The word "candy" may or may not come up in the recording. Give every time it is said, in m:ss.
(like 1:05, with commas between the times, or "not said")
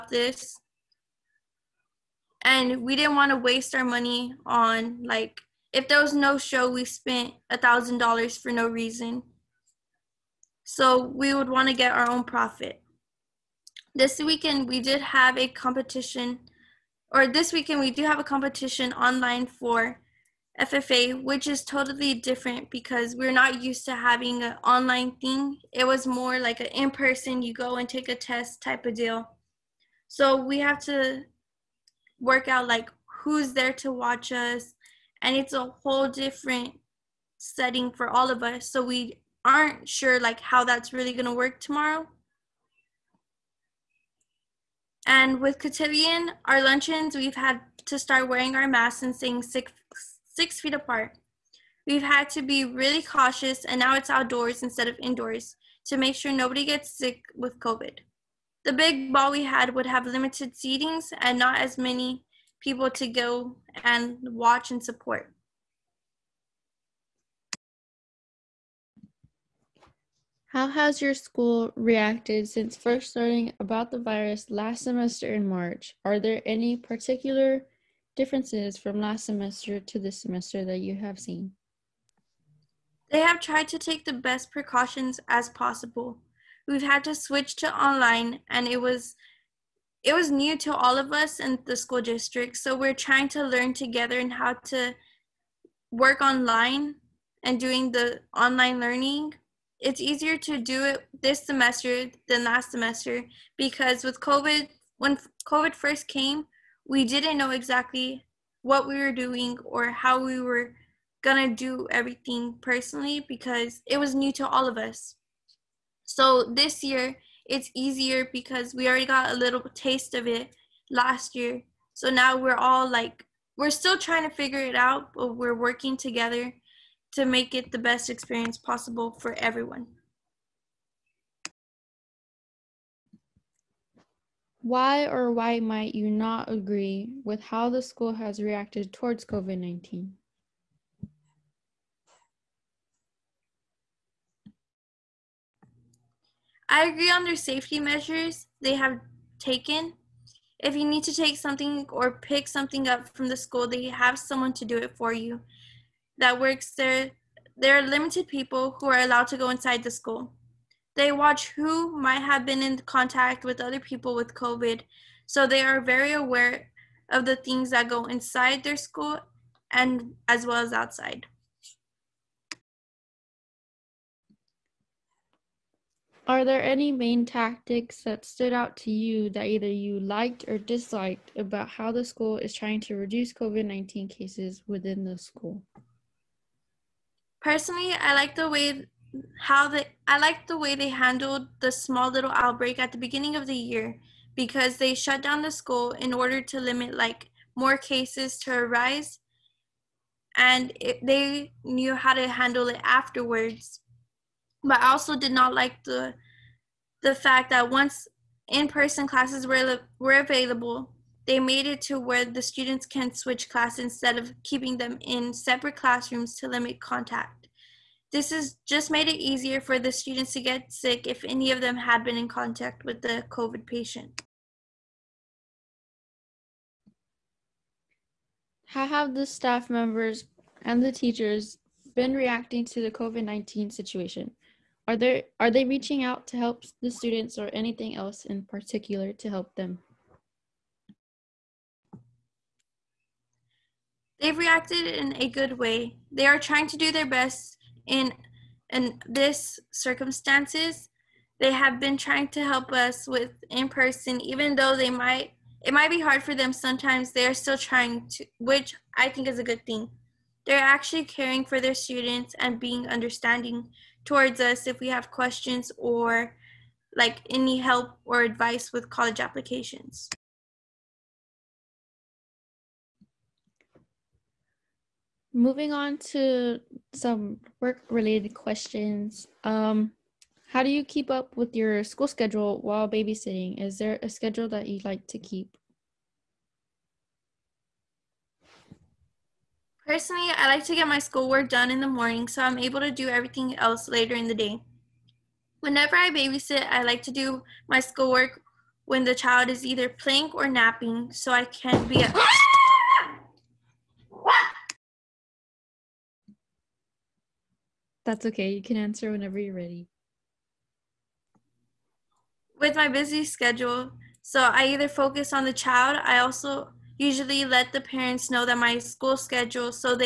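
not said.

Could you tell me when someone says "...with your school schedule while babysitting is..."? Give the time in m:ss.
4:41.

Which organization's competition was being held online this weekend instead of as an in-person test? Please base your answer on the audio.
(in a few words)
FFA.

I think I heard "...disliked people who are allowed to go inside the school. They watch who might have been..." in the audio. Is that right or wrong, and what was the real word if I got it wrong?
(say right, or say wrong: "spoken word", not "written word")
wrong: "limited", not "disliked".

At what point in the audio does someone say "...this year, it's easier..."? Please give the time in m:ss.
1:56.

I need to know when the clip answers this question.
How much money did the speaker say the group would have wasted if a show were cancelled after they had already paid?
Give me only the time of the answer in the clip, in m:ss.
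0:07.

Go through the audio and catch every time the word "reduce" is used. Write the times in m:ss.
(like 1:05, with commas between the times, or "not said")
3:02.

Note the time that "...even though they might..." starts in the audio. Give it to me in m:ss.
4:14.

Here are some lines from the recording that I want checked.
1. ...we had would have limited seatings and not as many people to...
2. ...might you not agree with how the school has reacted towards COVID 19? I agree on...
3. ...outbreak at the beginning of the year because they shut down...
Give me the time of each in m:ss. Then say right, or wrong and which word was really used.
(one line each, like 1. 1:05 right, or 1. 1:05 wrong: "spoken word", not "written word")
1. 0:59 right
2. 2:15 right
3. 3:12 right.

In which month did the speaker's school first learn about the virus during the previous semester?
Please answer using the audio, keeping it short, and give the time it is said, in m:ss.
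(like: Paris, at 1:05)
March, at 1:15.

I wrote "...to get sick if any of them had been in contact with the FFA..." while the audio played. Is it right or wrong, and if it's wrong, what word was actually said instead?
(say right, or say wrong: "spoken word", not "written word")
wrong: "COVID", not "FFA".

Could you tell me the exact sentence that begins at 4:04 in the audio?
They've reacted in a good way.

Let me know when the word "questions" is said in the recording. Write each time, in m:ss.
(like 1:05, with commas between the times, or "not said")
4:25, 4:38.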